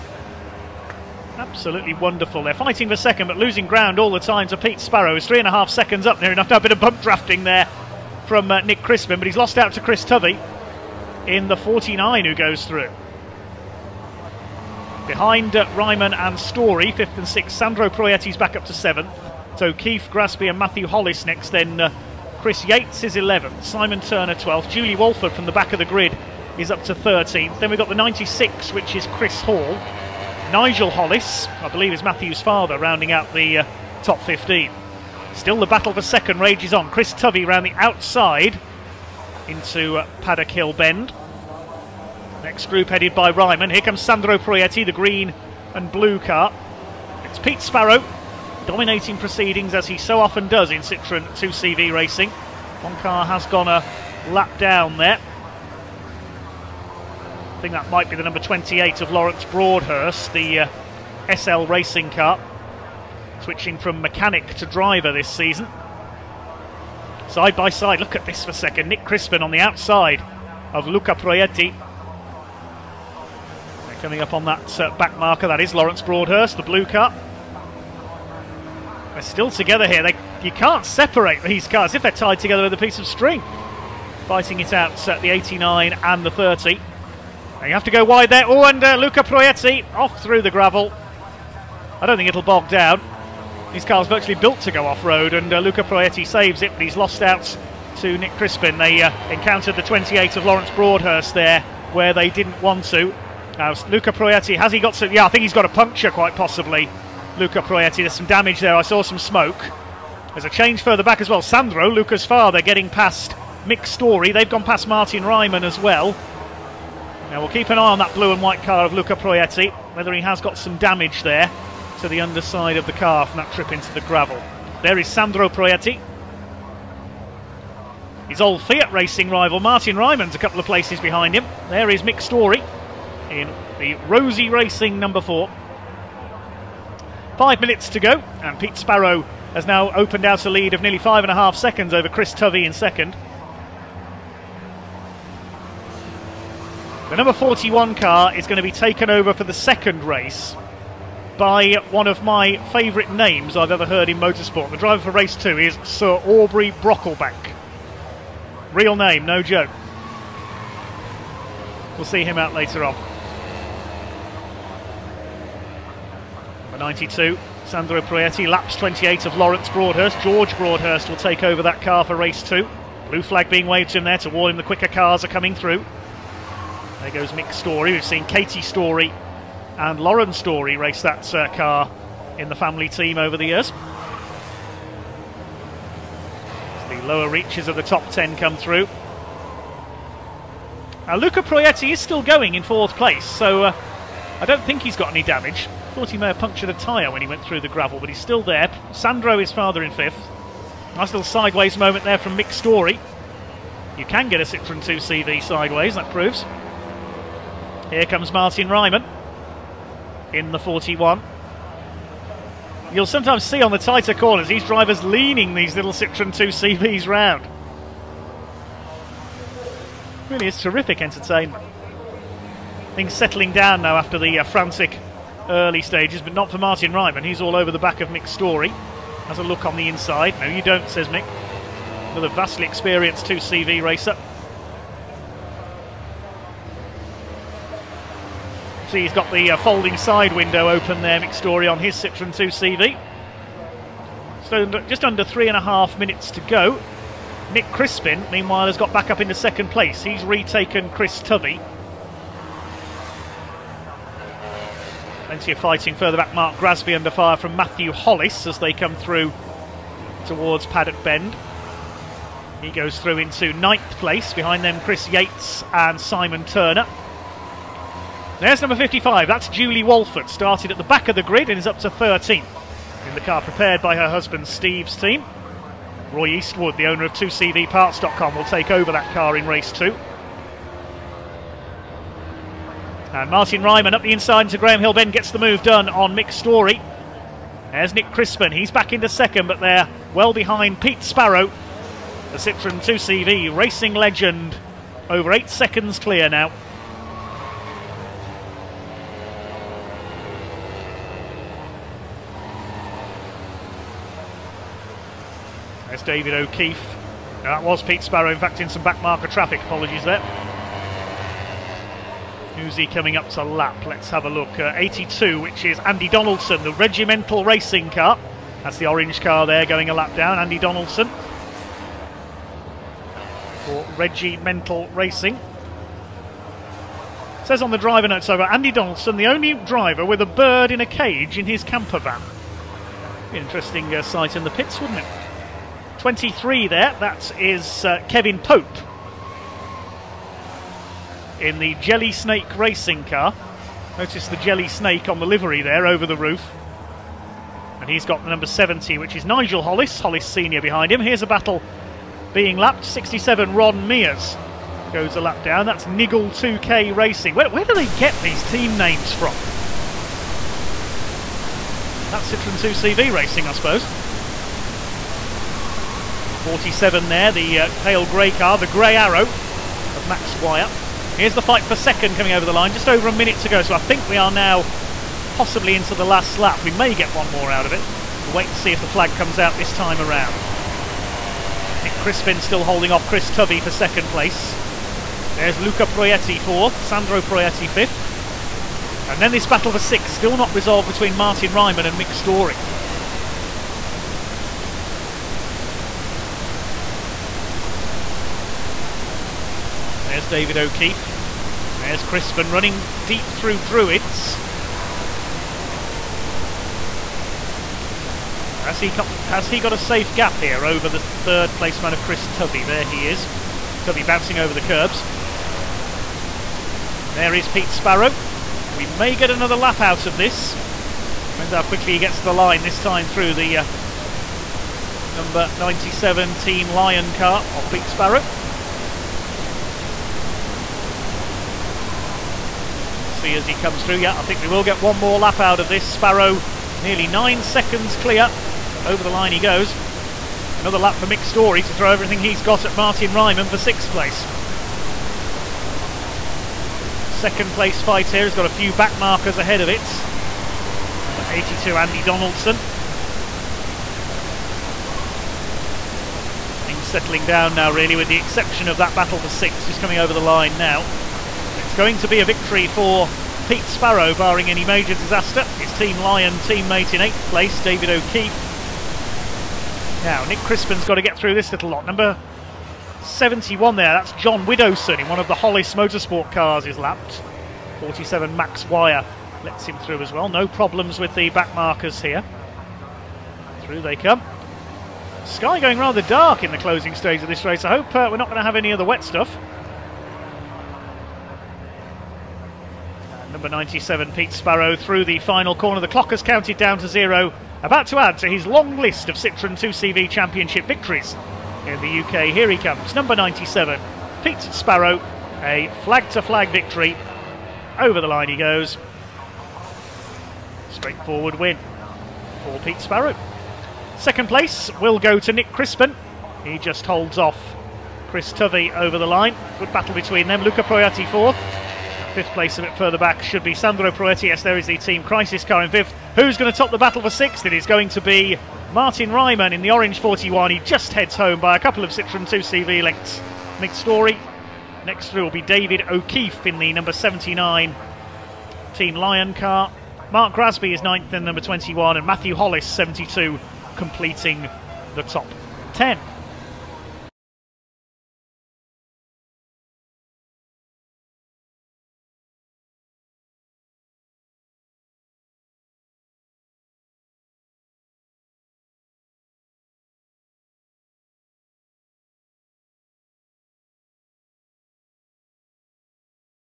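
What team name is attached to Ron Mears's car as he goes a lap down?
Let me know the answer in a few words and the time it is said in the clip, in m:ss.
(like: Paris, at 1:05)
Niggle 2K Racing, at 5:55.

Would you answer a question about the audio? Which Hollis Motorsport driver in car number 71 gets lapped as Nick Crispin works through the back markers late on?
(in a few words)
John Widowson.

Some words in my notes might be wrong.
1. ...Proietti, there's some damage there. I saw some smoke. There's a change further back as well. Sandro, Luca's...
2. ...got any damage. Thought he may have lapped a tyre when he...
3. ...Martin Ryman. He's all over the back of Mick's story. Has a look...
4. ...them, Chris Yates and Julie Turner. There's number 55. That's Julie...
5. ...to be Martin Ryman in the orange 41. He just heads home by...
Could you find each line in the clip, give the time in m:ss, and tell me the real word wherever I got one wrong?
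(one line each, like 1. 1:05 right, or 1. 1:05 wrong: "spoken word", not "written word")
1. 1:47 right
2. 3:14 wrong: "punctured", not "lapped"
3. 3:46 right
4. 4:24 wrong: "Simon", not "Julie"
5. 8:47 right.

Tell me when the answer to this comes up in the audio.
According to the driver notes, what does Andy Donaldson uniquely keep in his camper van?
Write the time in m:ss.
5:30.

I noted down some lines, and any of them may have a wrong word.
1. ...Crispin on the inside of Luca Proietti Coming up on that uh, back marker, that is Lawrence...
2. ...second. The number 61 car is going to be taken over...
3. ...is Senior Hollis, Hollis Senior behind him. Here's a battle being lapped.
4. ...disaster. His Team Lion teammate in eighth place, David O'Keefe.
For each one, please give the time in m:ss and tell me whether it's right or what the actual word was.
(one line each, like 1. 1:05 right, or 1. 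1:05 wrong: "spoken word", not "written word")
1. 1:09 wrong: "outside", not "inside"
2. 2:22 wrong: "41", not "61"
3. 5:49 wrong: "Nigel", not "Senior"
4. 7:44 right.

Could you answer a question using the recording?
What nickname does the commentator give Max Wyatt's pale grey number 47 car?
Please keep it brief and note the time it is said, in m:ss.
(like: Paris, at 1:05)
the grey arrow, at 6:08.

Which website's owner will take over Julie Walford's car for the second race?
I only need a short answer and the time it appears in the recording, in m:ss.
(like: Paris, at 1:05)
2CVParts.com, at 4:37.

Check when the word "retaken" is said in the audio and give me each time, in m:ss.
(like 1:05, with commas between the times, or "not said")
4:10.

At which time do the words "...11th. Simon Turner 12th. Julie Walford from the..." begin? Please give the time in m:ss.
0:23.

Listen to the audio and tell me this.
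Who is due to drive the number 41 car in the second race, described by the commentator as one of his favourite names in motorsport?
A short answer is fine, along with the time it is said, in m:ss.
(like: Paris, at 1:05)
Sir Aubrey Brocklebank, at 2:35.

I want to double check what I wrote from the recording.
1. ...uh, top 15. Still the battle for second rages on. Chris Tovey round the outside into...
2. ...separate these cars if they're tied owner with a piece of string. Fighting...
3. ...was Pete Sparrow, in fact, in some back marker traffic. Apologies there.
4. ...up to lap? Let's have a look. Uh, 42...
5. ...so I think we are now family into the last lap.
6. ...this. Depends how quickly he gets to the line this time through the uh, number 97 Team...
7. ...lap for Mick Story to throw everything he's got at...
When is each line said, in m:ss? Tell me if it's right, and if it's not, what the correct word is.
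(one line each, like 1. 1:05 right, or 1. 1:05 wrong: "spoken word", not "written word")
1. 0:33 right
2. 1:20 wrong: "together", not "owner"
3. 5:07 right
4. 5:13 wrong: "82", not "42"
5. 6:13 wrong: "possibly", not "family"
6. 7:00 right
7. 7:20 right.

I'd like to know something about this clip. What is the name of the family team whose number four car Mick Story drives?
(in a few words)
Rosie Racing.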